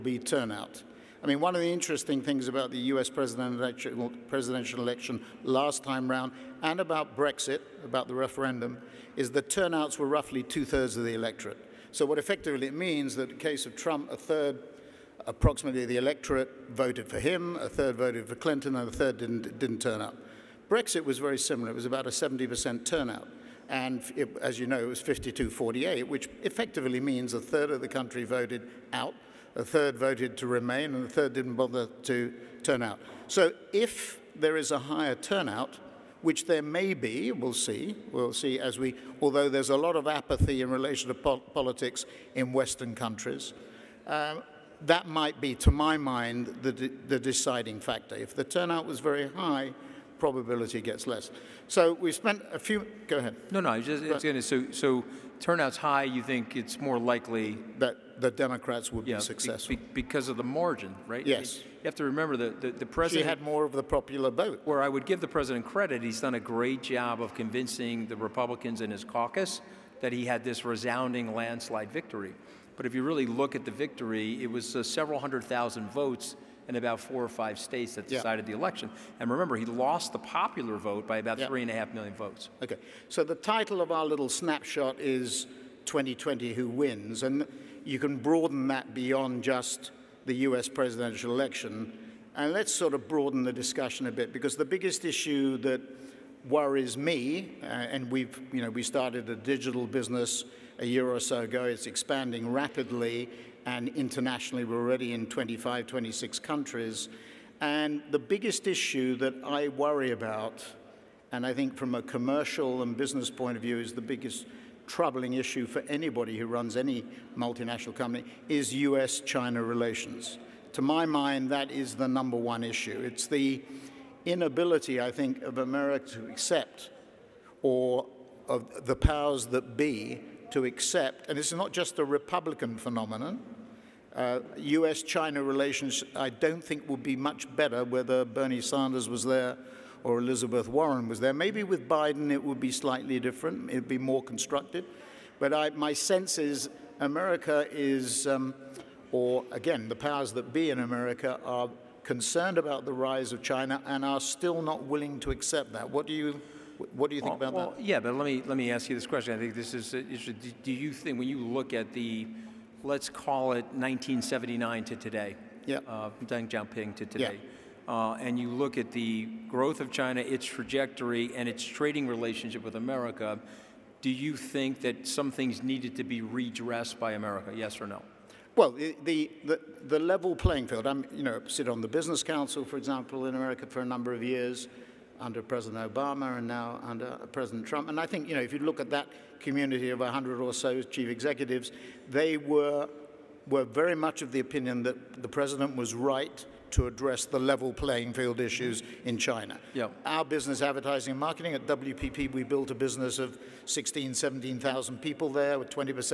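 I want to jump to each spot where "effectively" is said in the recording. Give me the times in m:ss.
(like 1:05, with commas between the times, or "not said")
0:12, 0:26.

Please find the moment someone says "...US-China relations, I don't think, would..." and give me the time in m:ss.
2:14.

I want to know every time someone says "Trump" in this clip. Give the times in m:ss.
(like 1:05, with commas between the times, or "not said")
0:13, 3:07.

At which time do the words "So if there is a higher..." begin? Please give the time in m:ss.
0:33.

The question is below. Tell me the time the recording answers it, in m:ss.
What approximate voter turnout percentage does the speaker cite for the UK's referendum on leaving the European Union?
0:22.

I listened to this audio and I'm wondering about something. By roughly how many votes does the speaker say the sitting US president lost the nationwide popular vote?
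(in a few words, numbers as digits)
3.5 million.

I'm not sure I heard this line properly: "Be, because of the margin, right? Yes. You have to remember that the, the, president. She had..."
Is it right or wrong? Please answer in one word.
right.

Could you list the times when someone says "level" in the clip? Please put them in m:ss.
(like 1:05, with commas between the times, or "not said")
2:59, 3:17.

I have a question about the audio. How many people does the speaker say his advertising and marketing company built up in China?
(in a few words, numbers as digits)
16,000 to 17,000.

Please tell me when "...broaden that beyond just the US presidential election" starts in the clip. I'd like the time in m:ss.
1:28.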